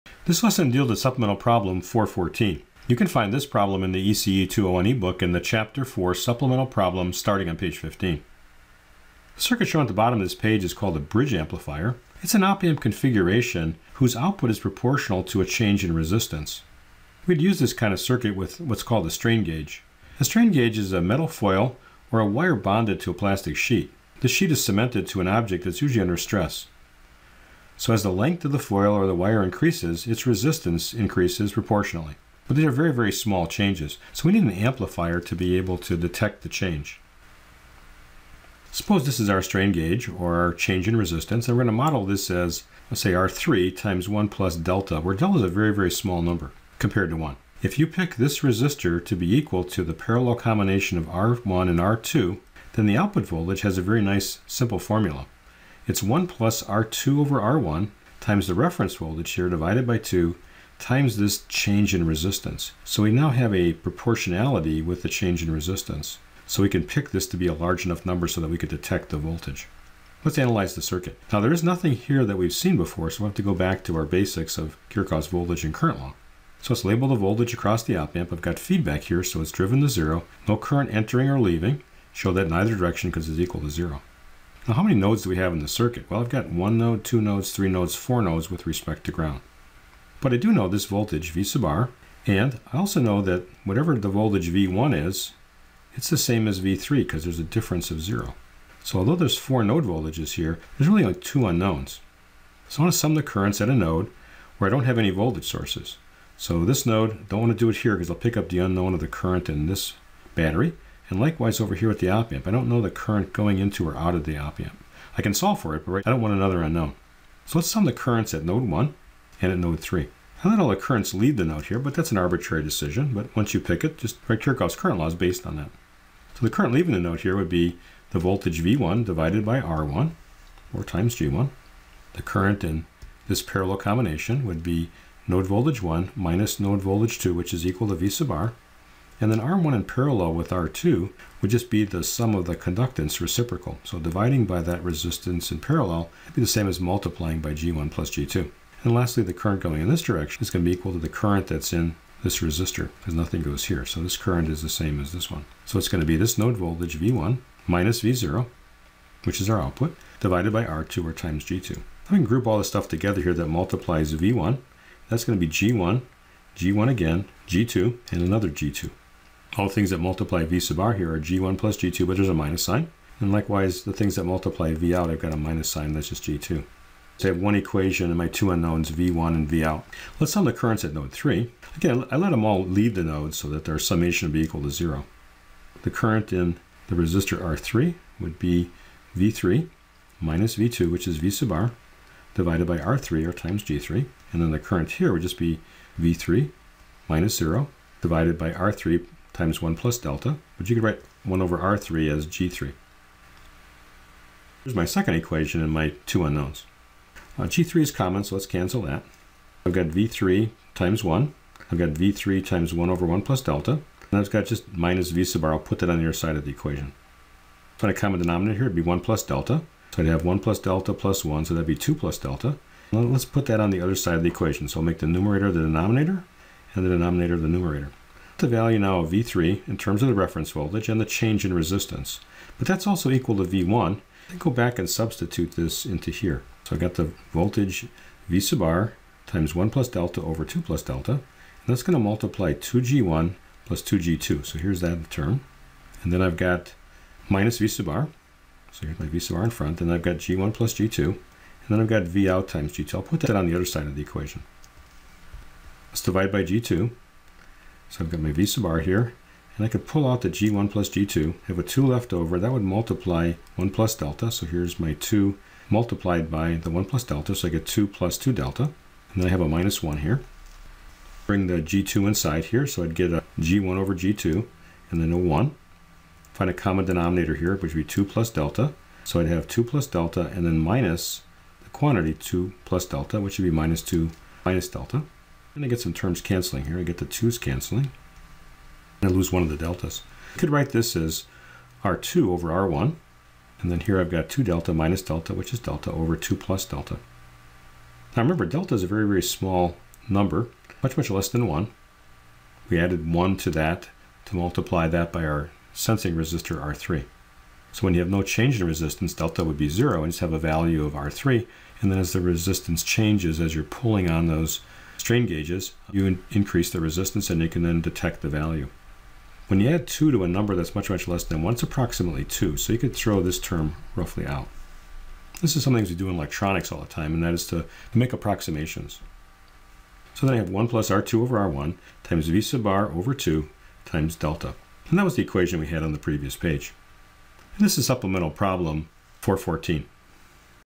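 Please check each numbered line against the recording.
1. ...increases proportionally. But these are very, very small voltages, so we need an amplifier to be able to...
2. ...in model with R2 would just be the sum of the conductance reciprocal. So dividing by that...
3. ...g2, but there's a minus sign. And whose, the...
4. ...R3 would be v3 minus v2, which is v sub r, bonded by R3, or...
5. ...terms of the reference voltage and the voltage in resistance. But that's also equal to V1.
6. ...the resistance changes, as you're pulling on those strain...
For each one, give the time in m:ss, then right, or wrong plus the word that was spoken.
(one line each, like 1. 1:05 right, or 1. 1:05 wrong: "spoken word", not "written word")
1. 0:30 wrong: "changes", not "voltages"
2. 2:19 wrong: "parallel", not "model"
3. 2:51 wrong: "likewise", not "whose"
4. 3:07 wrong: "divided", not "bonded"
5. 3:49 wrong: "change", not "voltage"
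6. 5:12 right.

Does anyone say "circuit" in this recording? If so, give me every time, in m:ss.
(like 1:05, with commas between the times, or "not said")
0:09, 0:17, 1:10, 1:25.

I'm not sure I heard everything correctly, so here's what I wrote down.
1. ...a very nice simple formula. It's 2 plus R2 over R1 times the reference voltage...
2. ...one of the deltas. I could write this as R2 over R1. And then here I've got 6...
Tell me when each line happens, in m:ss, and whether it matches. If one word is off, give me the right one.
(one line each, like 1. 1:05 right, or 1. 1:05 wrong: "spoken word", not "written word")
1. 0:53 wrong: "1", not "2"
2. 4:49 wrong: "2", not "6".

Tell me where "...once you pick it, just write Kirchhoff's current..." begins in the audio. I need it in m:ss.
2:03.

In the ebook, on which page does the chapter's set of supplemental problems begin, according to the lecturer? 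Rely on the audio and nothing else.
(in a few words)
15.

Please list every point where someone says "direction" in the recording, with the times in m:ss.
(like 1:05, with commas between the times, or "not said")
1:22, 2:30.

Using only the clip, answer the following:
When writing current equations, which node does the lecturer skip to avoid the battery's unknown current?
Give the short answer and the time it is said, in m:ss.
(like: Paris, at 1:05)
node 2, at 1:46.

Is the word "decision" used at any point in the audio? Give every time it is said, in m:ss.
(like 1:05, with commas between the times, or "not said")
2:02.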